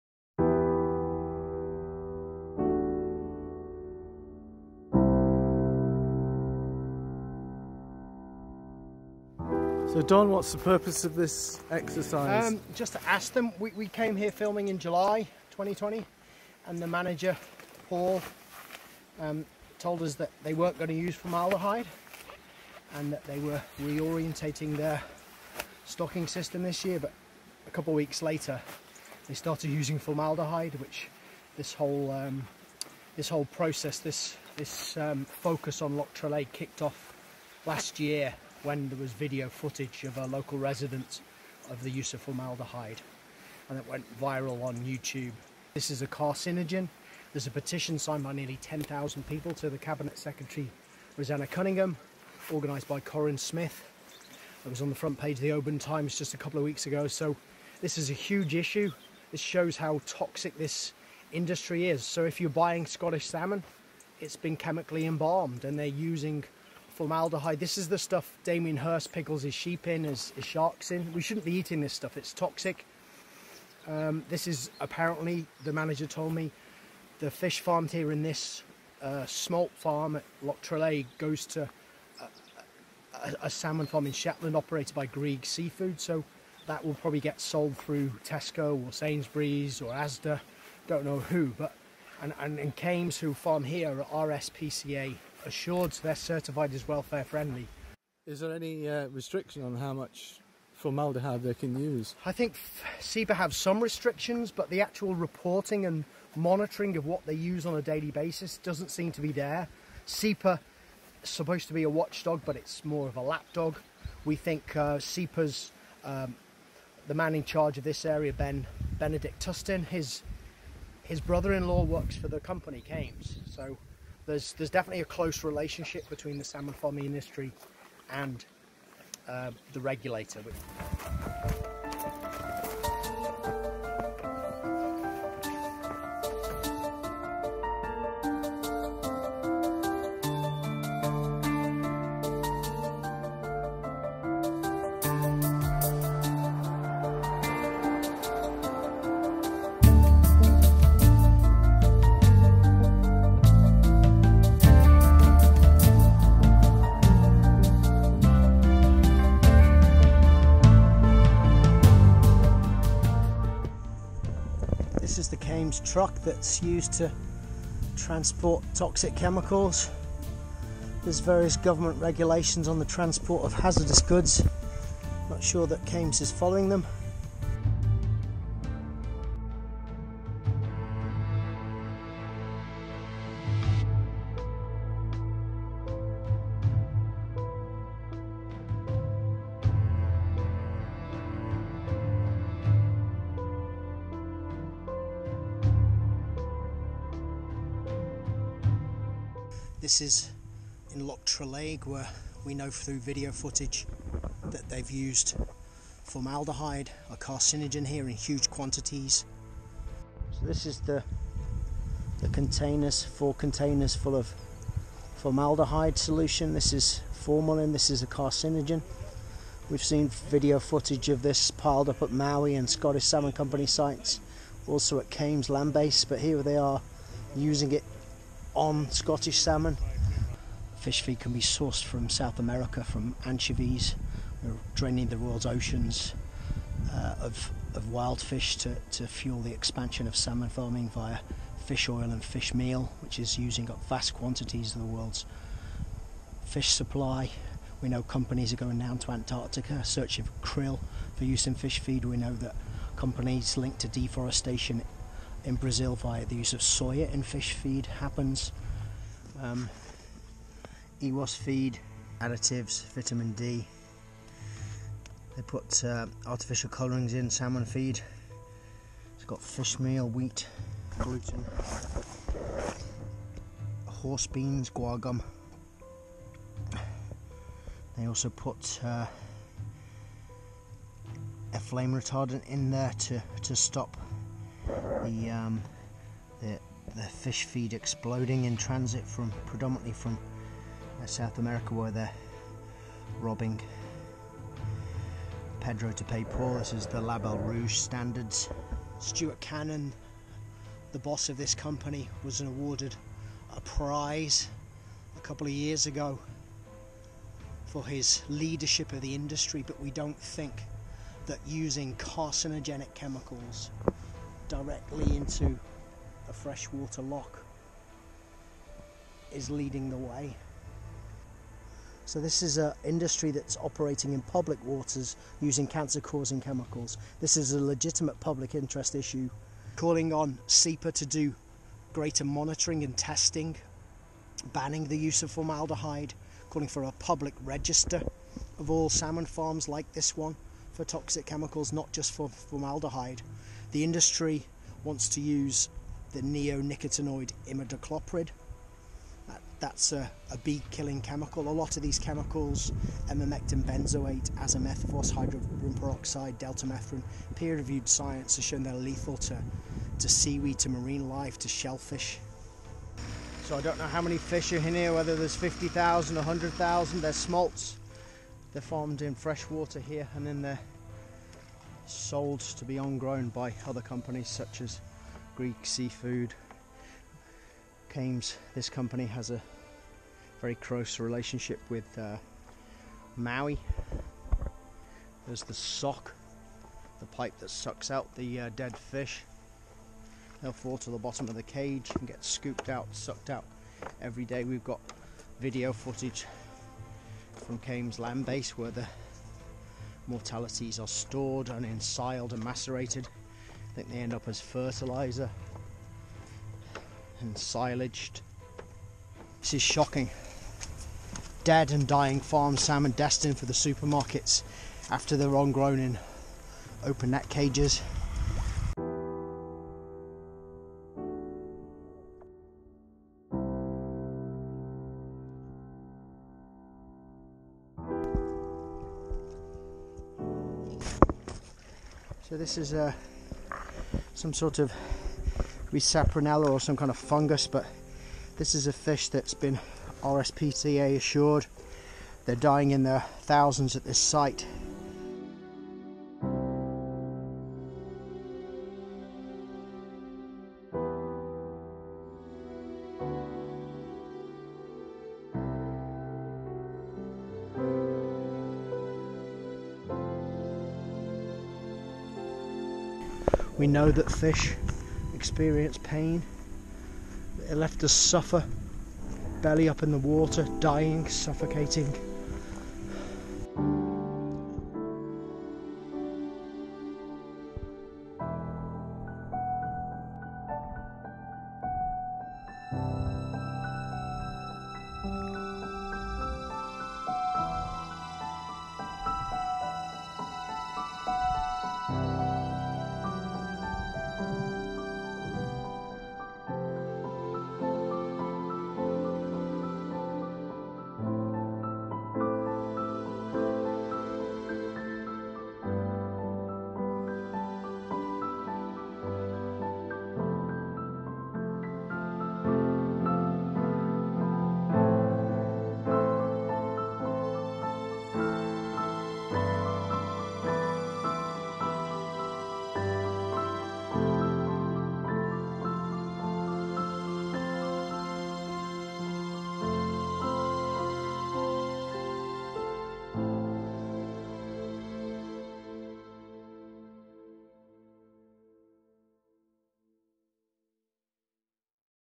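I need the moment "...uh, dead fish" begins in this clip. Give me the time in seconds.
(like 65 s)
388 s.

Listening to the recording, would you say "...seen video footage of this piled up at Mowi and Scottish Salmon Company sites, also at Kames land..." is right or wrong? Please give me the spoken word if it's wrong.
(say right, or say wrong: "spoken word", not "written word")
right.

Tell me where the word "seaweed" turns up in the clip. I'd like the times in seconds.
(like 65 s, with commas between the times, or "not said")
360 s.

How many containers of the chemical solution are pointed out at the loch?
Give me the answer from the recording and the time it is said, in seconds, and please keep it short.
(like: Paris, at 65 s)
4, at 213 s.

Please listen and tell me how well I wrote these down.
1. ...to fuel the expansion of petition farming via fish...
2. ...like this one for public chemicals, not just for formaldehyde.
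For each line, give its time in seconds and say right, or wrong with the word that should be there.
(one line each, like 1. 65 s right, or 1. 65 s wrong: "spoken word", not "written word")
1. 238 s wrong: "salmon", not "petition"
2. 339 s wrong: "toxic", not "public".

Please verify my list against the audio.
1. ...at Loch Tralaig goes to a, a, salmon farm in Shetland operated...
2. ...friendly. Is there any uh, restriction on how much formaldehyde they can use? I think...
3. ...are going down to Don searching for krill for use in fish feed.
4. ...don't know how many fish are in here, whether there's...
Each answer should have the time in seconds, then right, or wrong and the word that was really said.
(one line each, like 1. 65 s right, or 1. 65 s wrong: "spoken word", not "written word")
1. 80 s right
2. 97 s right
3. 248 s wrong: "Antarctica", not "Don"
4. 363 s right.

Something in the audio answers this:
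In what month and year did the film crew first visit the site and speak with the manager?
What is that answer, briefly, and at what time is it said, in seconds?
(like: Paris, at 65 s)
July 2020, at 14 s.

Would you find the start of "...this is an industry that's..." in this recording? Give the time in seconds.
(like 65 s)
322 s.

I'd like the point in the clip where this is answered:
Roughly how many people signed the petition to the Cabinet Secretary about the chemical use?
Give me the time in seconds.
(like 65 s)
48 s.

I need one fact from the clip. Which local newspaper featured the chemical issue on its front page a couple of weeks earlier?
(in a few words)
Oban Times.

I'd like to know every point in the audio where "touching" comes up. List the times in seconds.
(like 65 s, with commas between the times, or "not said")
not said.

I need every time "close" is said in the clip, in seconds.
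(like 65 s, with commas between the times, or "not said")
125 s, 380 s.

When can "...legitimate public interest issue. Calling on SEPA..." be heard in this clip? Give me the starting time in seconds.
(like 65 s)
327 s.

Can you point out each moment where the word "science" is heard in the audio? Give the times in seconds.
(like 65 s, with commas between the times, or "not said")
357 s.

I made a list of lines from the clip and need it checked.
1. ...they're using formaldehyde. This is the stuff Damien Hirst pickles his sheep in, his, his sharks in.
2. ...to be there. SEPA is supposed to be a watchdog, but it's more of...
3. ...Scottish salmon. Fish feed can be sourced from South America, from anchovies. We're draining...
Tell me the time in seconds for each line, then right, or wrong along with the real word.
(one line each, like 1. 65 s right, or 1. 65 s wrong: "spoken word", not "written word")
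1. 65 s right
2. 109 s right
3. 228 s right.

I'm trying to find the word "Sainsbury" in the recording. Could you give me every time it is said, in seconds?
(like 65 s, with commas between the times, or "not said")
88 s.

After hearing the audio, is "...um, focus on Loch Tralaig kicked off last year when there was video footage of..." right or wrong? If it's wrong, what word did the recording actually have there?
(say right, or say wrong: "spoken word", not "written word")
right.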